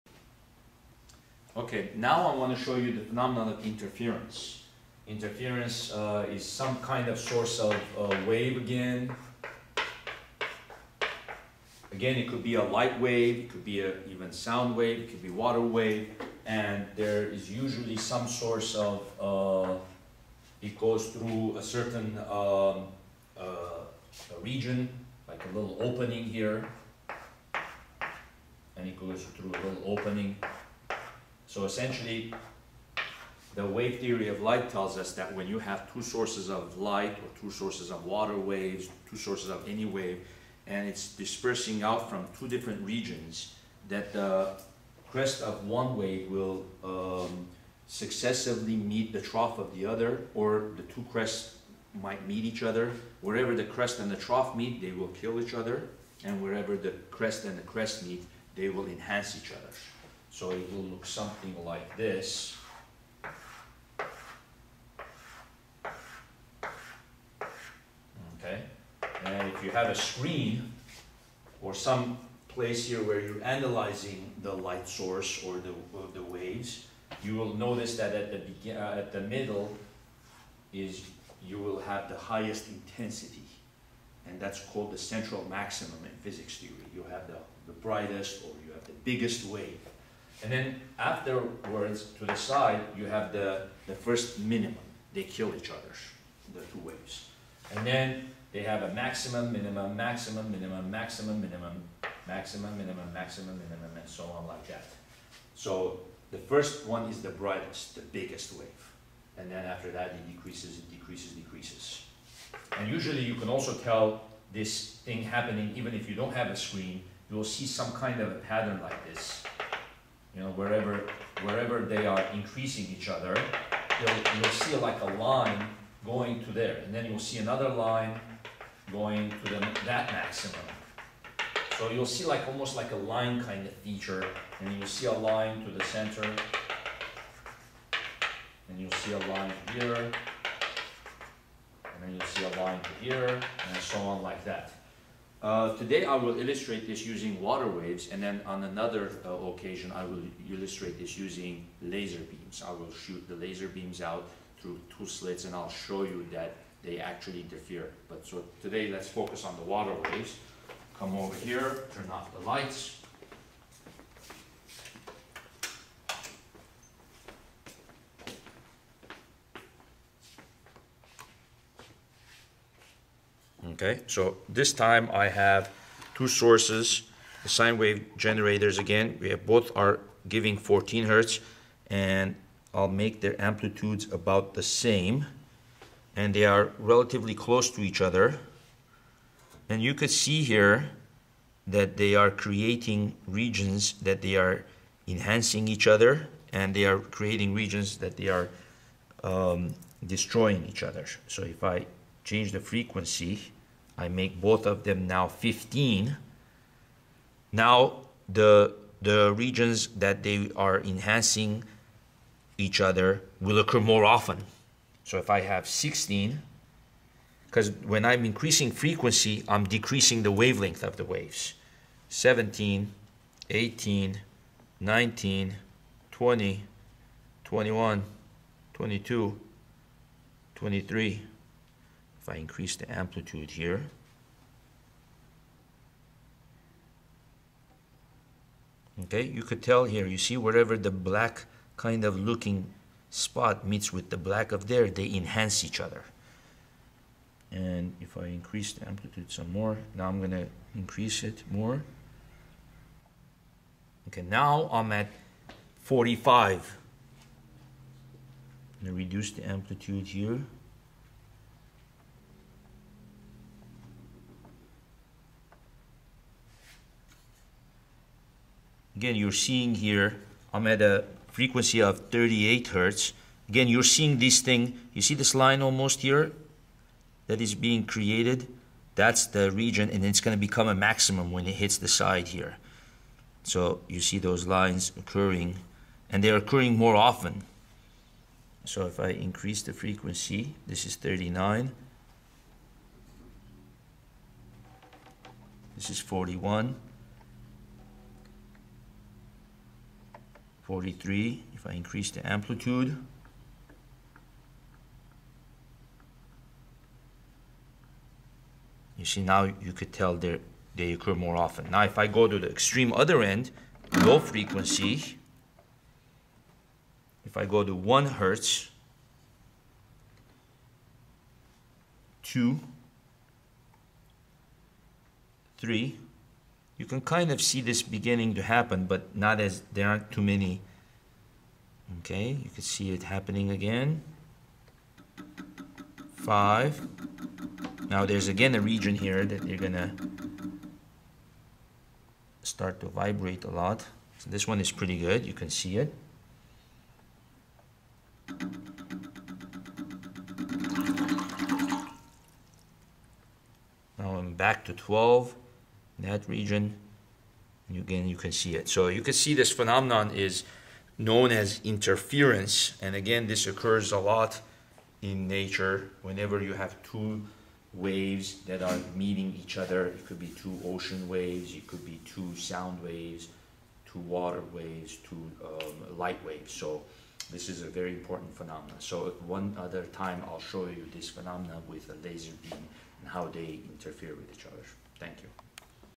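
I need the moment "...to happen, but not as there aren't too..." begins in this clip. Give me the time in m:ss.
5:28.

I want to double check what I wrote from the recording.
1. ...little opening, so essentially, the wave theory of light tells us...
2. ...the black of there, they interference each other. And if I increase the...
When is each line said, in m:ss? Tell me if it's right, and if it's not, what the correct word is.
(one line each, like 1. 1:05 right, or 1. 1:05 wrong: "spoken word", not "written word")
1. 0:29 right
2. 4:04 wrong: "enhance", not "interference".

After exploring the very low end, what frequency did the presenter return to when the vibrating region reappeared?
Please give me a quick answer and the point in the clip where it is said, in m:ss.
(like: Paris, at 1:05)
12, at 5:54.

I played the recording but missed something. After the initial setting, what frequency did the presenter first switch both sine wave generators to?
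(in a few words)
15.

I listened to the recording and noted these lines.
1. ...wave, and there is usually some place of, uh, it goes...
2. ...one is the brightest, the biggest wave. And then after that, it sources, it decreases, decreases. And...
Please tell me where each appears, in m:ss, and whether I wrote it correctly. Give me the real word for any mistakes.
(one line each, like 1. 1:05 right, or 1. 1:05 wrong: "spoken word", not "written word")
1. 0:15 wrong: "source", not "place"
2. 1:46 wrong: "decreases", not "sources".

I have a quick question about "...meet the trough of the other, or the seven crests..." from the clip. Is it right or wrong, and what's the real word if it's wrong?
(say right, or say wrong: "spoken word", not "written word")
wrong: "two", not "seven".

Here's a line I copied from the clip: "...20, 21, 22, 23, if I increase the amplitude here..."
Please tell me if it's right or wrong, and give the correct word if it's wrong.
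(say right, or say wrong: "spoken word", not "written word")
right.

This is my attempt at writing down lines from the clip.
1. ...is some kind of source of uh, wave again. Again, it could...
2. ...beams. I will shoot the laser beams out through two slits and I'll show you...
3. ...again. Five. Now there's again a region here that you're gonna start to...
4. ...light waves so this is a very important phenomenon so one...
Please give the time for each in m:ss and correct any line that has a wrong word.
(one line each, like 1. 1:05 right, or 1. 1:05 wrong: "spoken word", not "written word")
1. 0:06 right
2. 2:32 right
3. 5:33 right
4. 6:15 right.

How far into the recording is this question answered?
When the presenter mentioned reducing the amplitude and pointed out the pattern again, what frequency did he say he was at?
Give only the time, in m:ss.
4:32.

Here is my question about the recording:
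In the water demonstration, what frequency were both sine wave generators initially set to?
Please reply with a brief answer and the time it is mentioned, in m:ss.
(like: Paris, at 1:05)
14 hertz, at 3:00.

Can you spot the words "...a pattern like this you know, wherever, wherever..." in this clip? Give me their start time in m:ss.
1:58.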